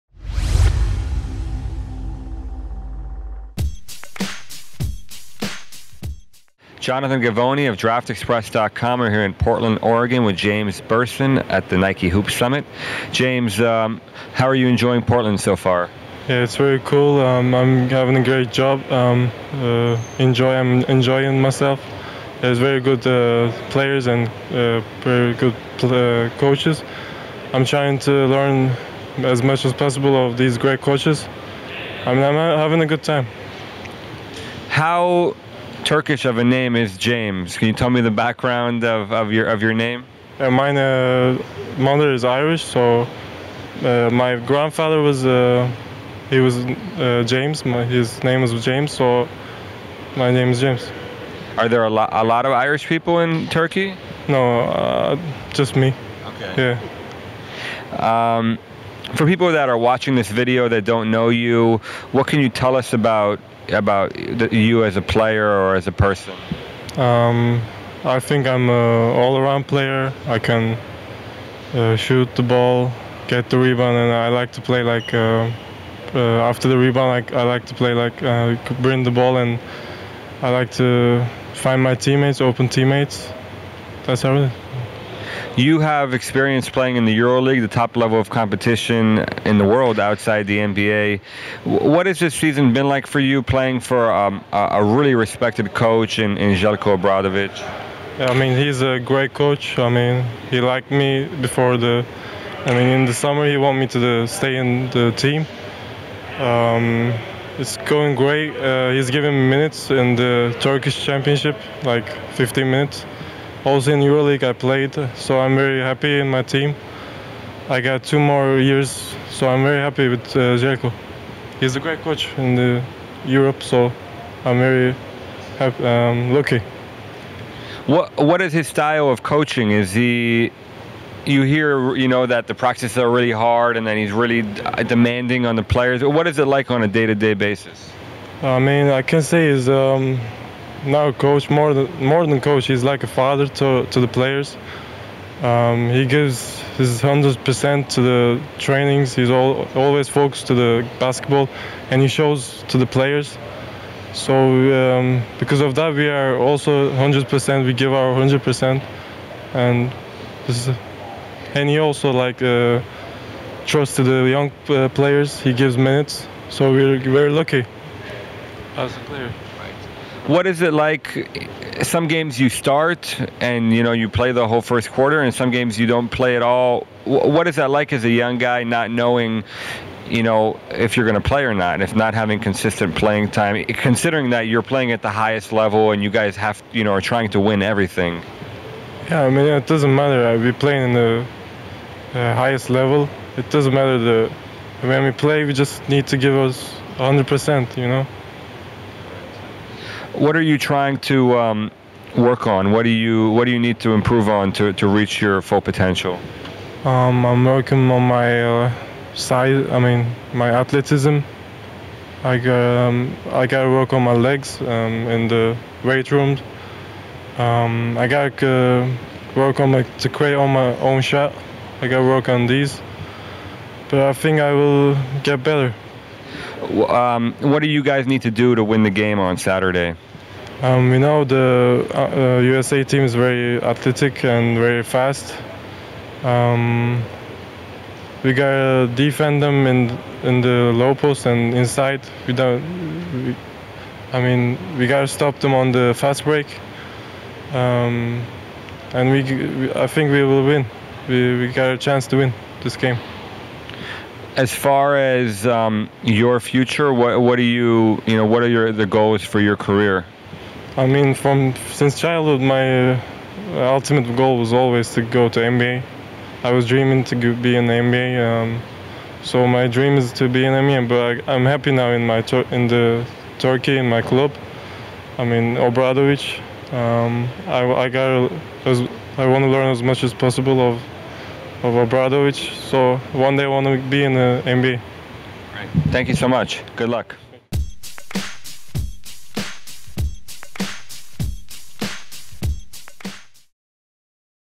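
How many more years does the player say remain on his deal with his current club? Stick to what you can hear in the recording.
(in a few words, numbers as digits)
2.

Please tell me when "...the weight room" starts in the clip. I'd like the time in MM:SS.
03:35.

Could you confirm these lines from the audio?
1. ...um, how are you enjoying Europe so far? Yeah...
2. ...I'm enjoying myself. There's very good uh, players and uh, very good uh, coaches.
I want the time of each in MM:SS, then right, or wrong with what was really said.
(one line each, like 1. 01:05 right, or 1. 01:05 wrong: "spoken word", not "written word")
1. 00:13 wrong: "Portland", not "Europe"
2. 00:20 right.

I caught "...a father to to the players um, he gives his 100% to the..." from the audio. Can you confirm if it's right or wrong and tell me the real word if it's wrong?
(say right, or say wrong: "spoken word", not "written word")
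right.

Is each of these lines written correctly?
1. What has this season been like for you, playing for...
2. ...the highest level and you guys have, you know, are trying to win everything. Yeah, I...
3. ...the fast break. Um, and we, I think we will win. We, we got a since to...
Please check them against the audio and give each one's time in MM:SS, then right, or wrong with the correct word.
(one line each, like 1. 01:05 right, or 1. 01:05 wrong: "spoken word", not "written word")
1. 01:31 right
2. 03:05 right
3. 04:05 wrong: "chance", not "since".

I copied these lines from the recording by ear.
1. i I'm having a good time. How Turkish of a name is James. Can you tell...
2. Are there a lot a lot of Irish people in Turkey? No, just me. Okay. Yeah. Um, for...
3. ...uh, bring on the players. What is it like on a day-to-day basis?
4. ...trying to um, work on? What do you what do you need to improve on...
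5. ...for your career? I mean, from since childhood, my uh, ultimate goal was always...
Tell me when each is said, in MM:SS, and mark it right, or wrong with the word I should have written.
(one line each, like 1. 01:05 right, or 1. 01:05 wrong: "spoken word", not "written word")
1. 00:32 right
2. 00:51 right
3. 02:14 wrong: "demanding", not "bring"
4. 03:20 right
5. 04:19 right.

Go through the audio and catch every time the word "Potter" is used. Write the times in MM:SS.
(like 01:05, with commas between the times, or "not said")
not said.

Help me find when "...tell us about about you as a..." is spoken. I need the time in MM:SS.
01:02.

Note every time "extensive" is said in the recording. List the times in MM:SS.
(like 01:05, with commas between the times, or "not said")
not said.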